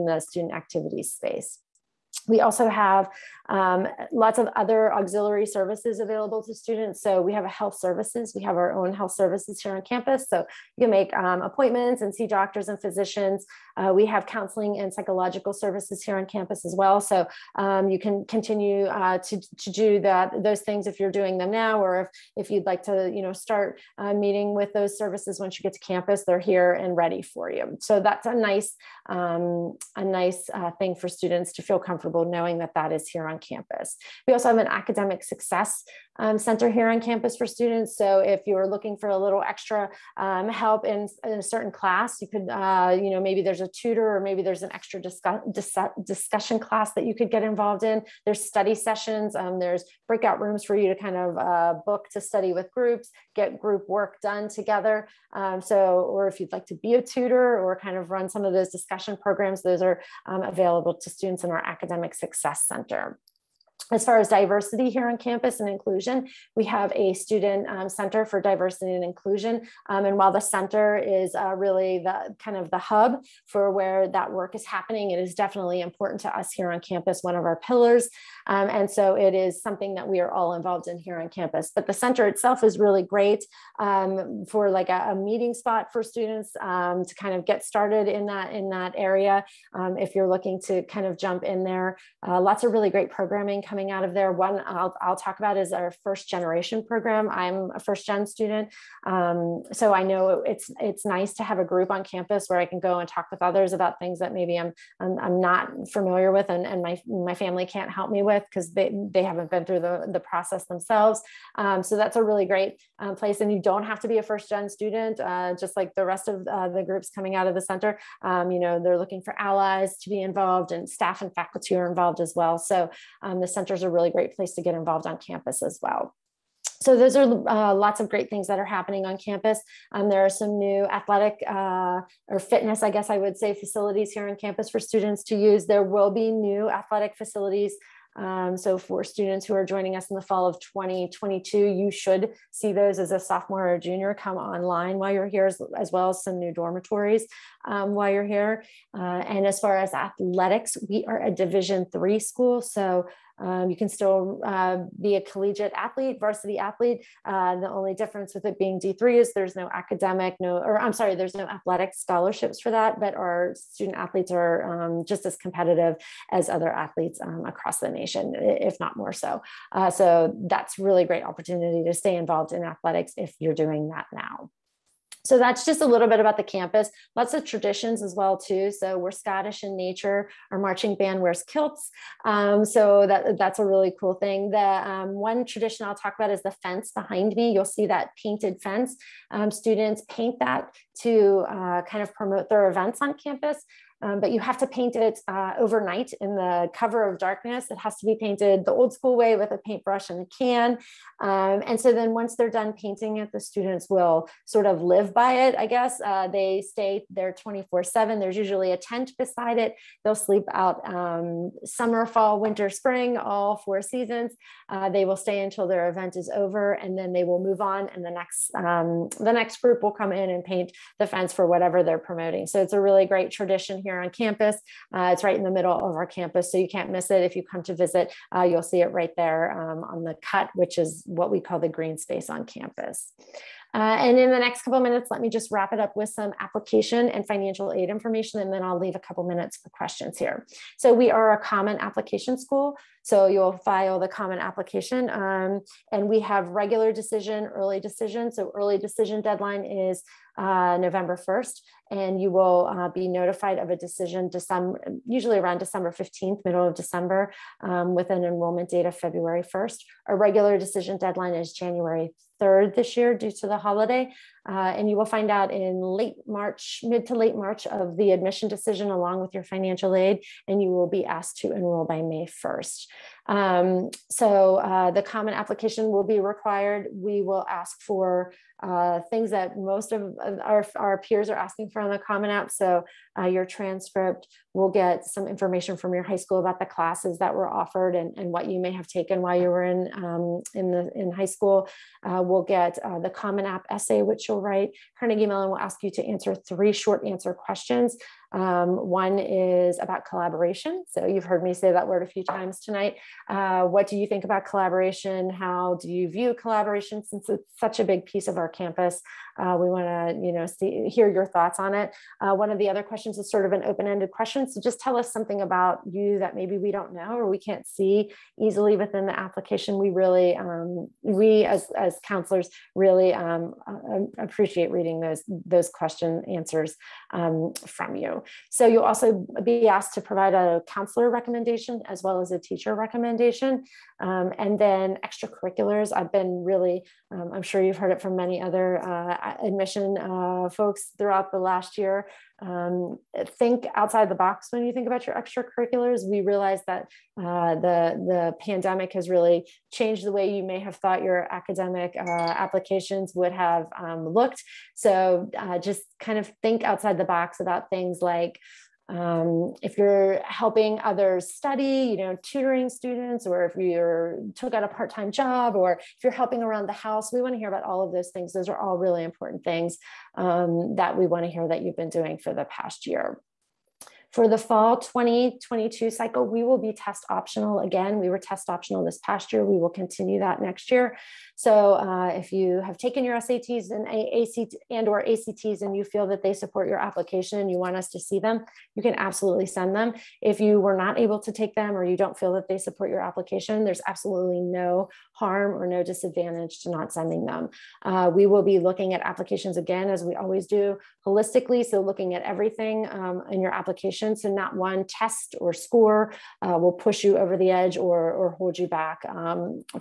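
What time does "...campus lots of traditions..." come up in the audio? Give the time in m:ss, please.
2:56.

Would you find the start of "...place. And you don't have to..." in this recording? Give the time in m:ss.
1:53.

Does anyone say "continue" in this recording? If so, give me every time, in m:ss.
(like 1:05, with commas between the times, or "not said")
0:18, 6:19.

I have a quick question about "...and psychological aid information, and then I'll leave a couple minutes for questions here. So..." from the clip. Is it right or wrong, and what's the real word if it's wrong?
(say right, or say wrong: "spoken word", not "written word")
wrong: "financial", not "psychological".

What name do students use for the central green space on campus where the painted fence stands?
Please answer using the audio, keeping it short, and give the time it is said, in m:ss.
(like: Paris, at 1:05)
the cut, at 3:50.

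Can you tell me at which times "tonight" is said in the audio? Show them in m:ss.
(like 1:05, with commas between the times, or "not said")
5:02.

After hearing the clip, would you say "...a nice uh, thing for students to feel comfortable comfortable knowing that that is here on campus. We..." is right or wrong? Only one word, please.
right.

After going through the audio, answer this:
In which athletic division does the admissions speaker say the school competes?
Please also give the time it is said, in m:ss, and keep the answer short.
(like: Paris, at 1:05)
Division 3, at 2:31.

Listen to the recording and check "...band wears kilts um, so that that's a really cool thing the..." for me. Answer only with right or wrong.
right.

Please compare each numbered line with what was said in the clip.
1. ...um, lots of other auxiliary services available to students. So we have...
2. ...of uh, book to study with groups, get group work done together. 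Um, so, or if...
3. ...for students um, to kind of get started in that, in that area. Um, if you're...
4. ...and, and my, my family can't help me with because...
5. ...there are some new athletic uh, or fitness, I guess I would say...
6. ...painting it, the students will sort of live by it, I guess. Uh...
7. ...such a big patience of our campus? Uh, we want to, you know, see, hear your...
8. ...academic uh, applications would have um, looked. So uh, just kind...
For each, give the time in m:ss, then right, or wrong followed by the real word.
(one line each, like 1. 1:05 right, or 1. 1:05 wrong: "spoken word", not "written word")
1. 0:03 right
2. 0:51 right
3. 1:25 right
4. 1:46 right
5. 2:10 right
6. 3:22 right
7. 5:07 wrong: "piece", not "patience"
8. 5:51 right.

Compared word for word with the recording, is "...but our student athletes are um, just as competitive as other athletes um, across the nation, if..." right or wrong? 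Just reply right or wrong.
right.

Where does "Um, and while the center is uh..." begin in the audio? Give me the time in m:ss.
1:09.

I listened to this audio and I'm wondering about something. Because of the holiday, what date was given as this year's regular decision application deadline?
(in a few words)
January 3rd.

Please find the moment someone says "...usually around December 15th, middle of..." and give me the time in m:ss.
4:15.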